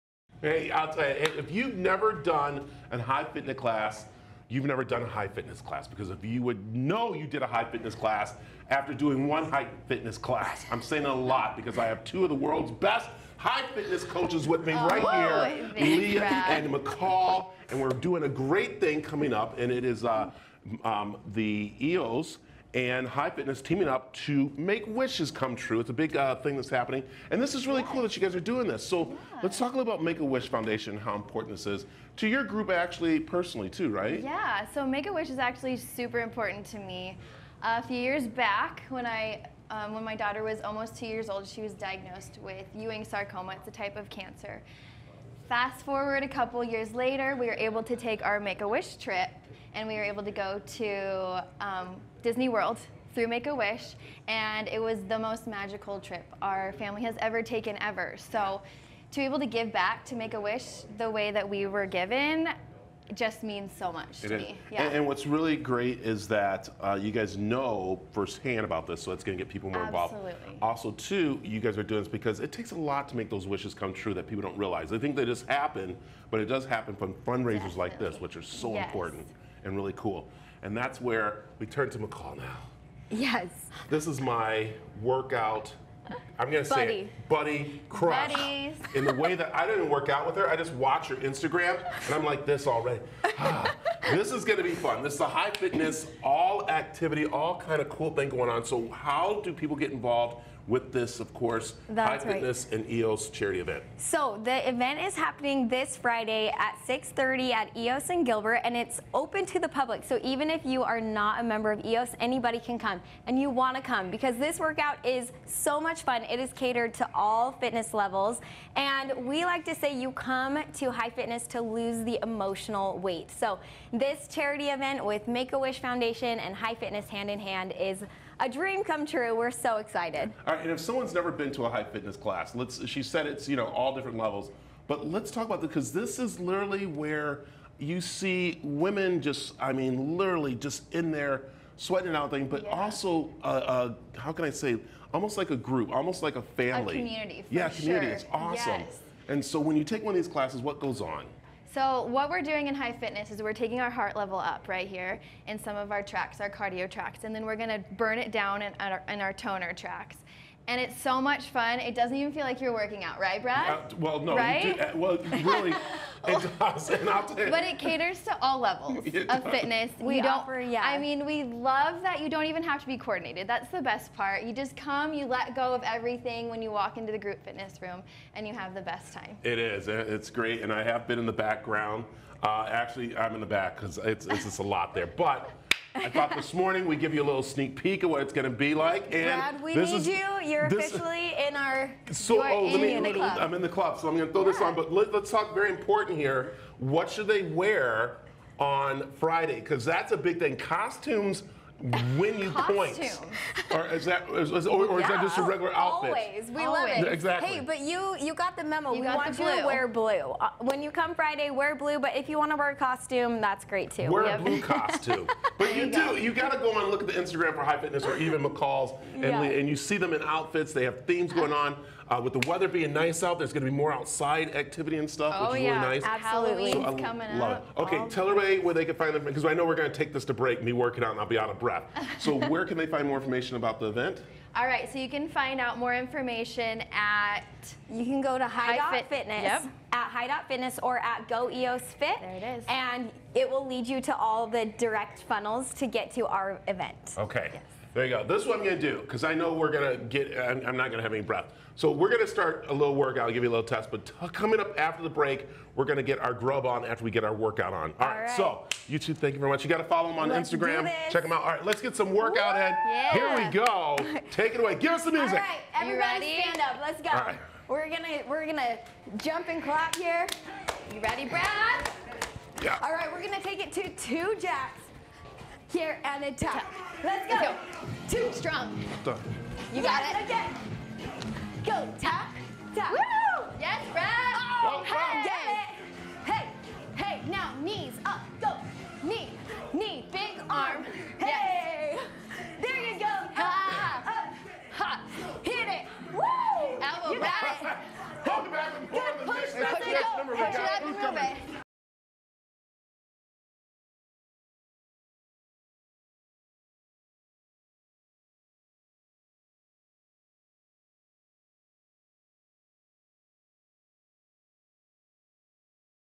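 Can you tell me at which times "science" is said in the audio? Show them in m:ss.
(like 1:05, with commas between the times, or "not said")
not said.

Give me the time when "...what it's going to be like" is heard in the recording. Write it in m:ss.
3:08.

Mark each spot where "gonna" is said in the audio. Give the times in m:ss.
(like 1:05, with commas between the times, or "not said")
1:26, 2:37, 4:33.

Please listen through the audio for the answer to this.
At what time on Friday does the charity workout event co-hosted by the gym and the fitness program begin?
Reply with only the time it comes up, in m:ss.
1:46.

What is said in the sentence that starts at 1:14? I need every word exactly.
They think they just happen, but it does happen from fundraisers Definitely.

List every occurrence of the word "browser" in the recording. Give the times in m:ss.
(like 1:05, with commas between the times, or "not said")
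not said.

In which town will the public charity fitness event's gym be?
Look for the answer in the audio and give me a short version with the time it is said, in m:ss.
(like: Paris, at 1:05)
Gilbert, at 1:48.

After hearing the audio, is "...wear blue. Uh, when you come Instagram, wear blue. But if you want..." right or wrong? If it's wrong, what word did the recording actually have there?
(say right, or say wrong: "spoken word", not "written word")
wrong: "Friday", not "Instagram".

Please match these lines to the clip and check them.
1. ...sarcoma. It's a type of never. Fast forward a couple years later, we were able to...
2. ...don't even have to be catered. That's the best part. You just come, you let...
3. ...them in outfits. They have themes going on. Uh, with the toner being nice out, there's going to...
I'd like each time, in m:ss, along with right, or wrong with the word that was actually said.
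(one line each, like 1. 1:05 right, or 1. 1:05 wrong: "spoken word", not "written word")
1. 0:43 wrong: "cancer", not "never"
2. 2:52 wrong: "coordinated", not "catered"
3. 3:39 wrong: "weather", not "toner".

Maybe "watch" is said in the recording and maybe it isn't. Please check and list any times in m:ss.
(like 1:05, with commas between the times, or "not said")
1:30.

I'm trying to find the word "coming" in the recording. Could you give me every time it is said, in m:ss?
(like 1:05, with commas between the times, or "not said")
0:19, 3:46, 4:14.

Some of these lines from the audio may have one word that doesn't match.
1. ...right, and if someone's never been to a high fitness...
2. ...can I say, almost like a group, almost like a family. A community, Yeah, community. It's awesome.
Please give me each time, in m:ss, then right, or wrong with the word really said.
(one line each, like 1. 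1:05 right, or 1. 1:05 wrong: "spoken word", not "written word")
1. 2:10 right
2. 2:24 right.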